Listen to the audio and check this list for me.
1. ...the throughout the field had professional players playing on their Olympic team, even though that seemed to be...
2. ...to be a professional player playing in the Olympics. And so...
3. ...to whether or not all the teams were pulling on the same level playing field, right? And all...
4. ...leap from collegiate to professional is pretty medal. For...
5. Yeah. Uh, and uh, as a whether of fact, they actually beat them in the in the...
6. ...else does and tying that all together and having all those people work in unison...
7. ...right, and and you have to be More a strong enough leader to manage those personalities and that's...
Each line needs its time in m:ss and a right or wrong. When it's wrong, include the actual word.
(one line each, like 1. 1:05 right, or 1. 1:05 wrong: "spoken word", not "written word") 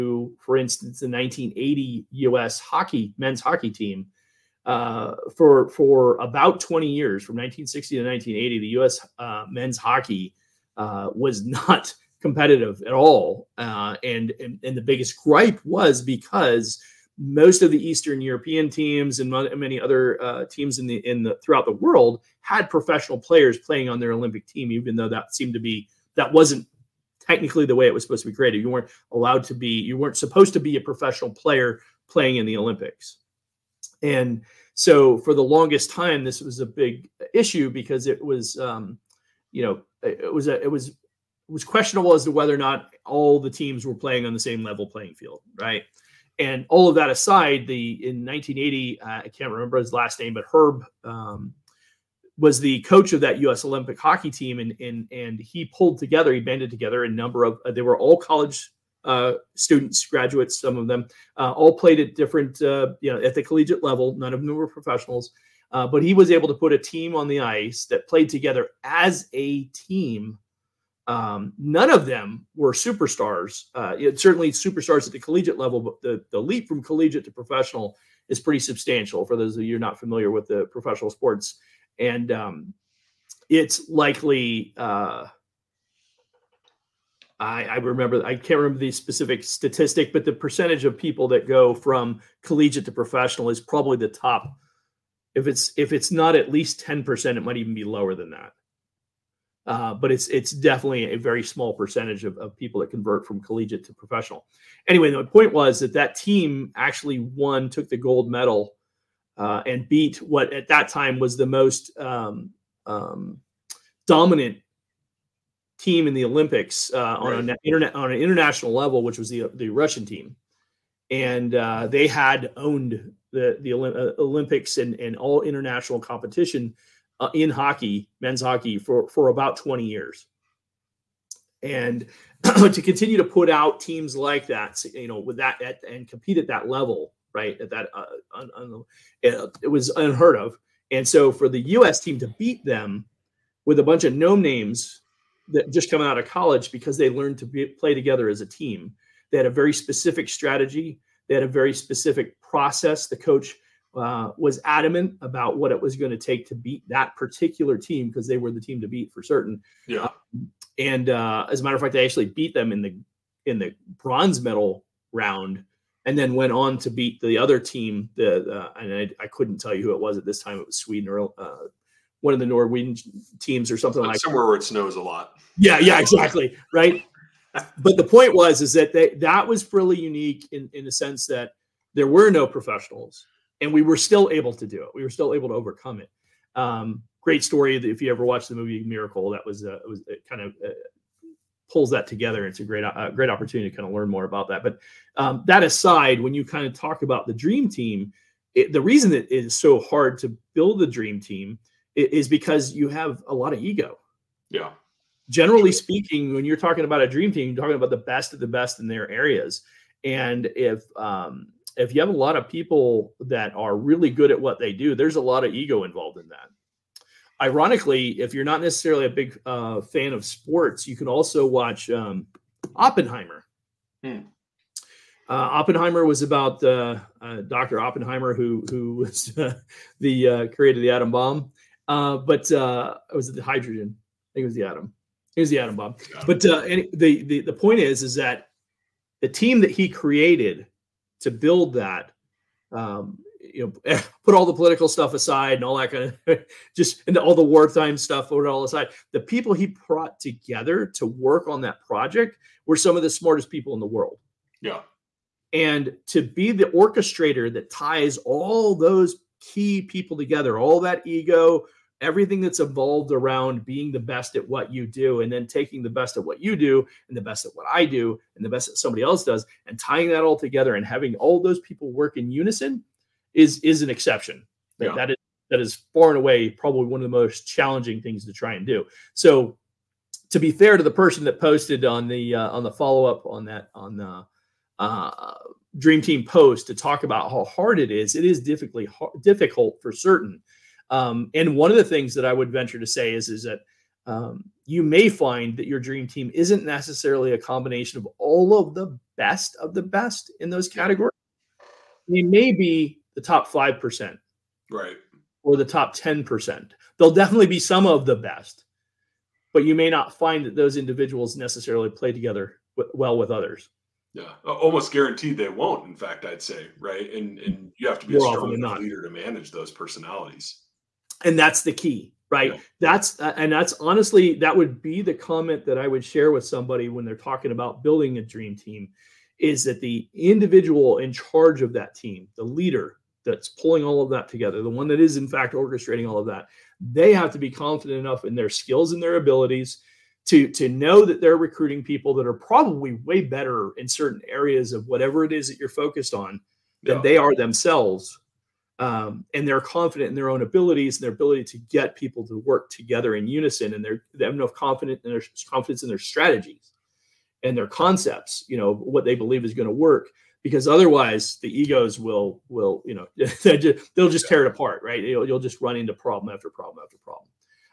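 1. 0:21 wrong: "world", not "field"
2. 0:30 right
3. 0:42 wrong: "playing", not "pulling"
4. 1:16 wrong: "substantial", not "medal"
5. 2:39 wrong: "matter", not "whether"
6. 4:29 right
7. 5:16 right.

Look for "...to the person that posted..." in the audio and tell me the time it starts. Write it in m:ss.
4:40.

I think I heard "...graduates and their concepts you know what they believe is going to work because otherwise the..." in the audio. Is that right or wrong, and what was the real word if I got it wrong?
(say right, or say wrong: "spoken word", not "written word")
wrong: "strategies", not "graduates".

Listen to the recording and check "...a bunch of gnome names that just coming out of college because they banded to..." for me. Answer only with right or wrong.
wrong.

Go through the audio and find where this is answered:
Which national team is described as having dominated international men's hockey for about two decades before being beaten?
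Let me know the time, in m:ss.
1:59.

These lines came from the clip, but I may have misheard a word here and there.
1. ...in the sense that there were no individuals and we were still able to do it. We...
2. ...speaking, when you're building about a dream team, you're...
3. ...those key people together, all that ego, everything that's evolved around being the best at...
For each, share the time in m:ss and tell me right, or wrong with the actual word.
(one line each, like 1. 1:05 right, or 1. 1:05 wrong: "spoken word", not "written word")
1. 3:00 wrong: "professionals", not "individuals"
2. 3:25 wrong: "talking", not "building"
3. 4:18 right.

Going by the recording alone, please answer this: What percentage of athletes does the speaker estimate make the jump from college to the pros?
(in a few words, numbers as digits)
10 percent.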